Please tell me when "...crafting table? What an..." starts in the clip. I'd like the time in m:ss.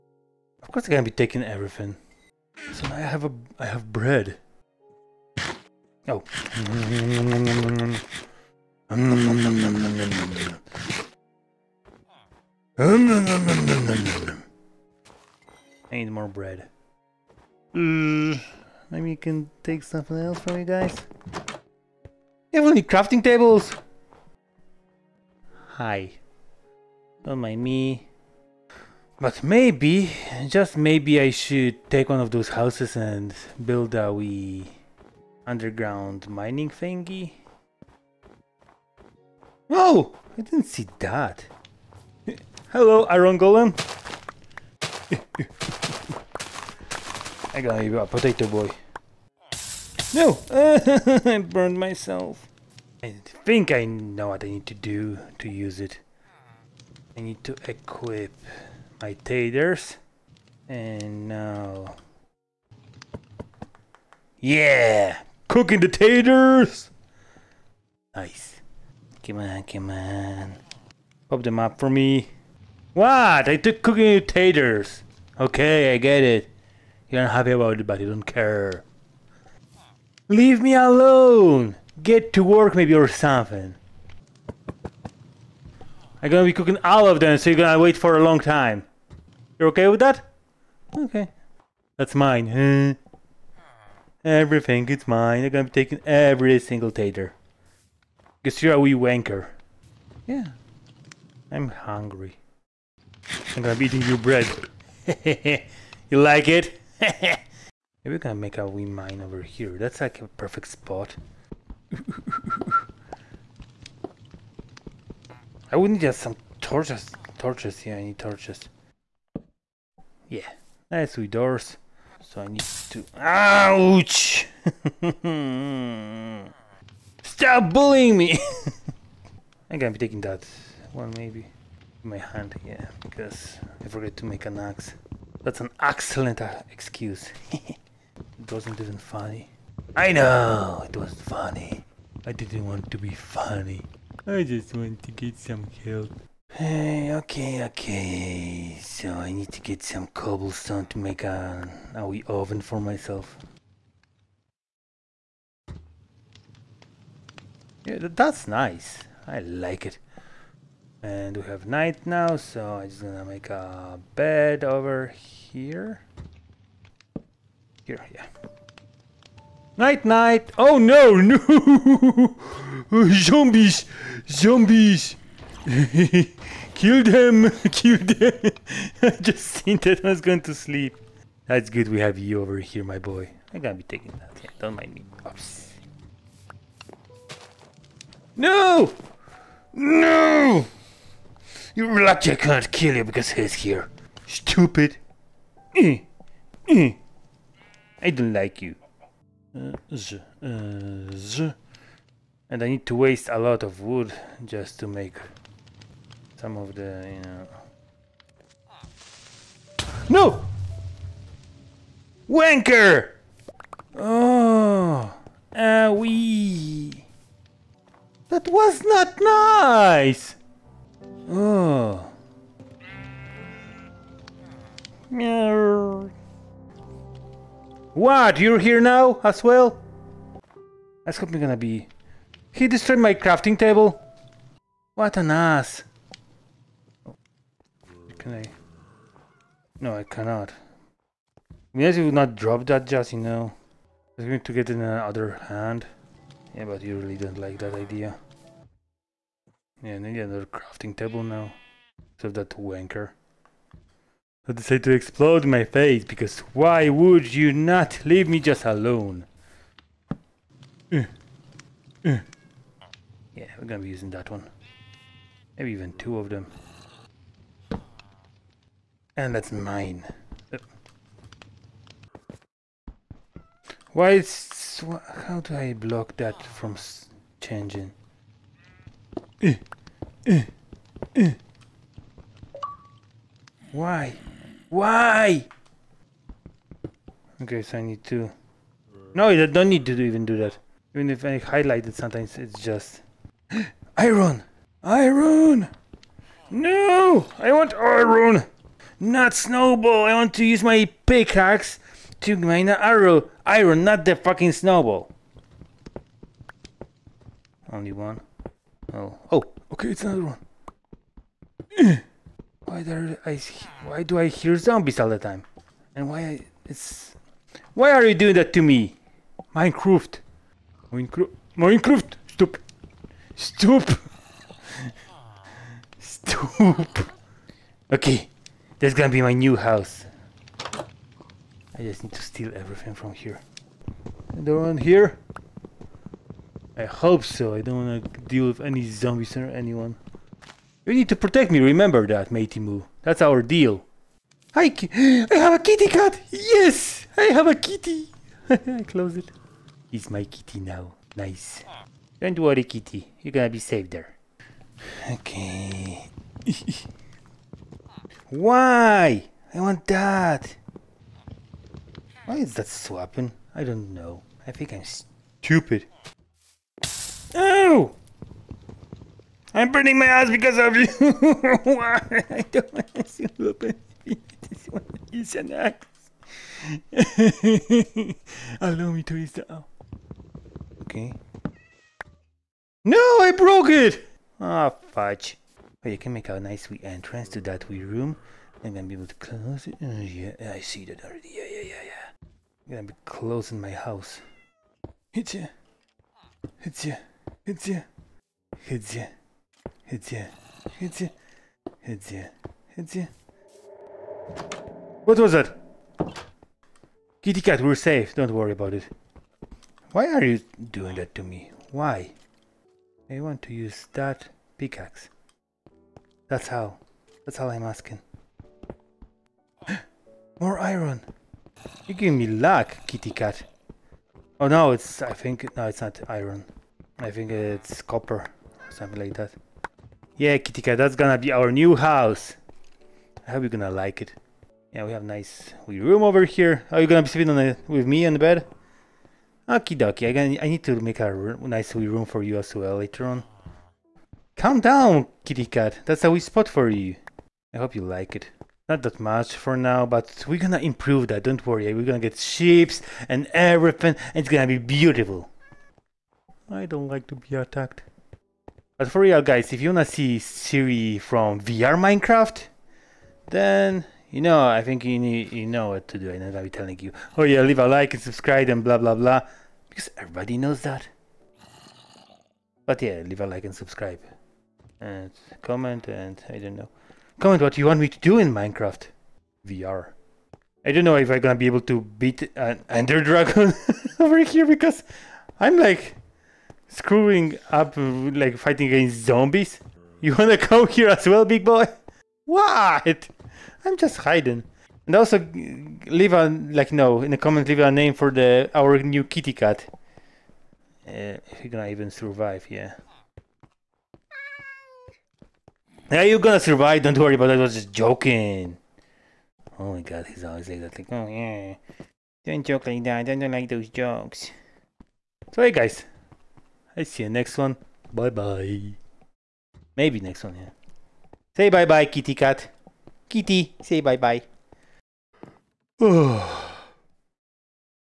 3:53.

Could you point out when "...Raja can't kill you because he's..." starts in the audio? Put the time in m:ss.
3:11.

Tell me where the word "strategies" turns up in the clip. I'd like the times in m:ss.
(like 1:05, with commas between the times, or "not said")
not said.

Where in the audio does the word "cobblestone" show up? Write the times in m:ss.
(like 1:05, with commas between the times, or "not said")
2:30.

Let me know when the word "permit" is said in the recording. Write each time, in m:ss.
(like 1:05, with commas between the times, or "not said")
not said.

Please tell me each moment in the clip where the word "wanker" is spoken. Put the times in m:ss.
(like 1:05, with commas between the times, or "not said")
1:38, 3:32, 4:12.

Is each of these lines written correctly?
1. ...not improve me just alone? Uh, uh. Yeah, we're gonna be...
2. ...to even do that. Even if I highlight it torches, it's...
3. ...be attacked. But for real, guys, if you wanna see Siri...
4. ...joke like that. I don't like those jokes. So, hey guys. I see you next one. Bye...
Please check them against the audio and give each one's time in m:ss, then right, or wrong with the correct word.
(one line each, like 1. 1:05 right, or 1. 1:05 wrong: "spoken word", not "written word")
1. 4:17 wrong: "leave", not "improve"
2. 4:49 wrong: "sometimes", not "torches"
3. 7:37 right
4. 8:32 right.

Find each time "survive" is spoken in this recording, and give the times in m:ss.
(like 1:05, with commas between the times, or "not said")
8:21, 8:26.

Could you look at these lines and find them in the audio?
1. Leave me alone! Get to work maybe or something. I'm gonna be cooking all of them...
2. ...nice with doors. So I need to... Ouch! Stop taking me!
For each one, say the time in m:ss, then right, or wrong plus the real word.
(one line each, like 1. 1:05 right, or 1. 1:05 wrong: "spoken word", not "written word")
1. 1:20 right
2. 2:00 wrong: "bullying", not "taking".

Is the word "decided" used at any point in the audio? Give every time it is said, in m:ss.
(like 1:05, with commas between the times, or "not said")
4:14.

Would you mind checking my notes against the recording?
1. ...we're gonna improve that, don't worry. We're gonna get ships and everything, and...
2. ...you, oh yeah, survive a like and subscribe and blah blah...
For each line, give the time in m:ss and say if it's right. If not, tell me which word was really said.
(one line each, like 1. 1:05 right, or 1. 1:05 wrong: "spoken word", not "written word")
1. 7:30 right
2. 7:46 wrong: "leave", not "survive".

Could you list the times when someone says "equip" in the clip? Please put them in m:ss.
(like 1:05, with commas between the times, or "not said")
0:57.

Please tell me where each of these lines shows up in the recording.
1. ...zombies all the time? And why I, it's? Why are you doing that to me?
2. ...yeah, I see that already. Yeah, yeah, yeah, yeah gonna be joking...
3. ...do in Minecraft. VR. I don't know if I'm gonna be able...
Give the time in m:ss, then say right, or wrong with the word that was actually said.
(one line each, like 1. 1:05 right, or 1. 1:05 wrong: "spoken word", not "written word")
1. 5:14 right
2. 6:29 wrong: "closing", not "joking"
3. 7:57 right.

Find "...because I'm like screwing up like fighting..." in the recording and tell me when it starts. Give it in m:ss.
8:04.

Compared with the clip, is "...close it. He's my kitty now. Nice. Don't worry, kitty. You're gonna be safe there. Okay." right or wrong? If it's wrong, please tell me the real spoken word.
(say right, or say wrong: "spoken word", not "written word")
right.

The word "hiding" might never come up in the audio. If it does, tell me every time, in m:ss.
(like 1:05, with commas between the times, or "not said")
8:13.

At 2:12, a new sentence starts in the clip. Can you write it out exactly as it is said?
My hand, yeah, because I forgot to make an axe.